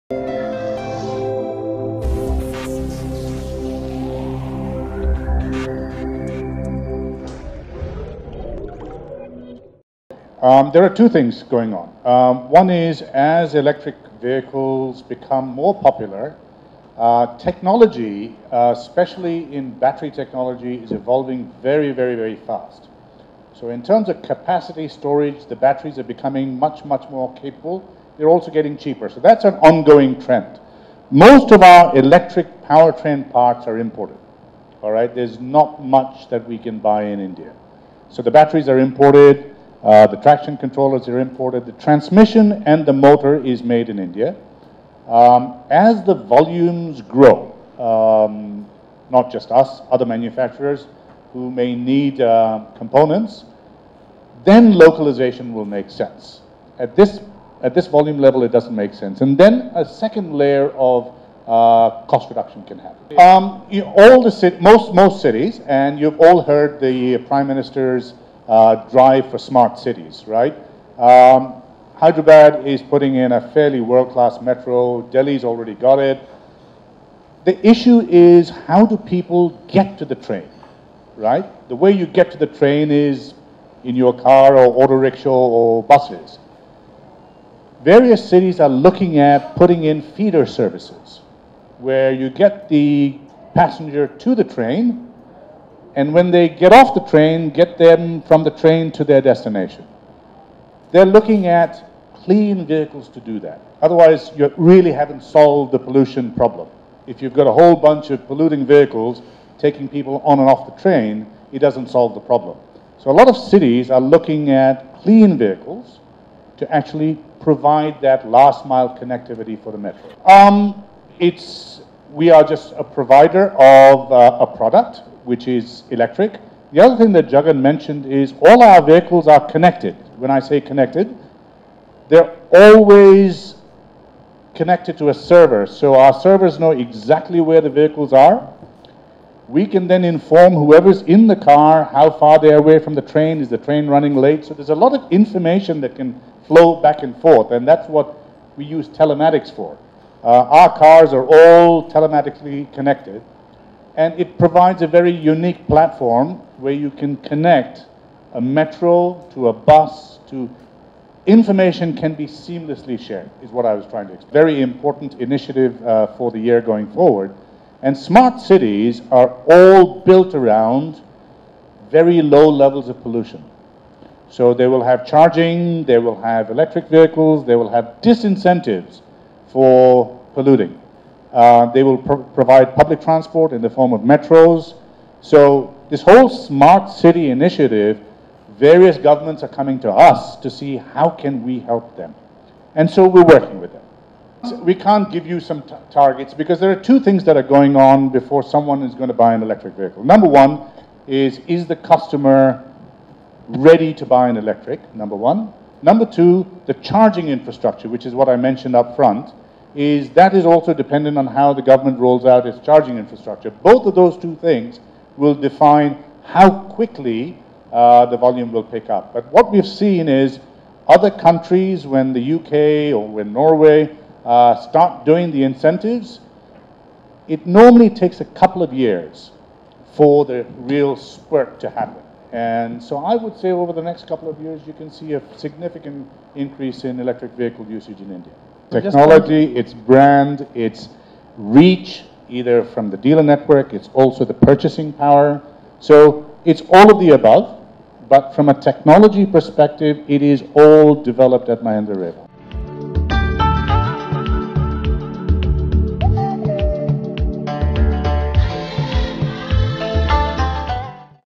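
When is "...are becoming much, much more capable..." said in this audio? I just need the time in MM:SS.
00:25.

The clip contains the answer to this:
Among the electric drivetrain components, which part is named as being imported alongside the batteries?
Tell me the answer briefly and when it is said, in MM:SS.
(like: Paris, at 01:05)
Traction controllers, at 00:40.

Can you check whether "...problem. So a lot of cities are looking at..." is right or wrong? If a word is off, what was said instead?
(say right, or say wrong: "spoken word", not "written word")
right.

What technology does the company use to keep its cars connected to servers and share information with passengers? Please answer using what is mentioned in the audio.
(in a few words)
Telematics.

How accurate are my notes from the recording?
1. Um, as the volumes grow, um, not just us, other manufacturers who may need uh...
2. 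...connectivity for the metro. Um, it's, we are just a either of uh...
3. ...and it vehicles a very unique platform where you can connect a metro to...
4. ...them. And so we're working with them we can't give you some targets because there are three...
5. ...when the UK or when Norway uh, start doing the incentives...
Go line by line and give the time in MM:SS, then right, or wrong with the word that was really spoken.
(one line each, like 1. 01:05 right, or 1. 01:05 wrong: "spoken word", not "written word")
1. 00:45 right
2. 01:58 wrong: "provider", not "either"
3. 02:33 wrong: "provides", not "vehicles"
4. 03:11 wrong: "two", not "three"
5. 03:41 right.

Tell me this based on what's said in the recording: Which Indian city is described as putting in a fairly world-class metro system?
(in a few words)
Hyderabad.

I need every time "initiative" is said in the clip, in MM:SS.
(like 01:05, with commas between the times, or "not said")
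02:45, 03:07.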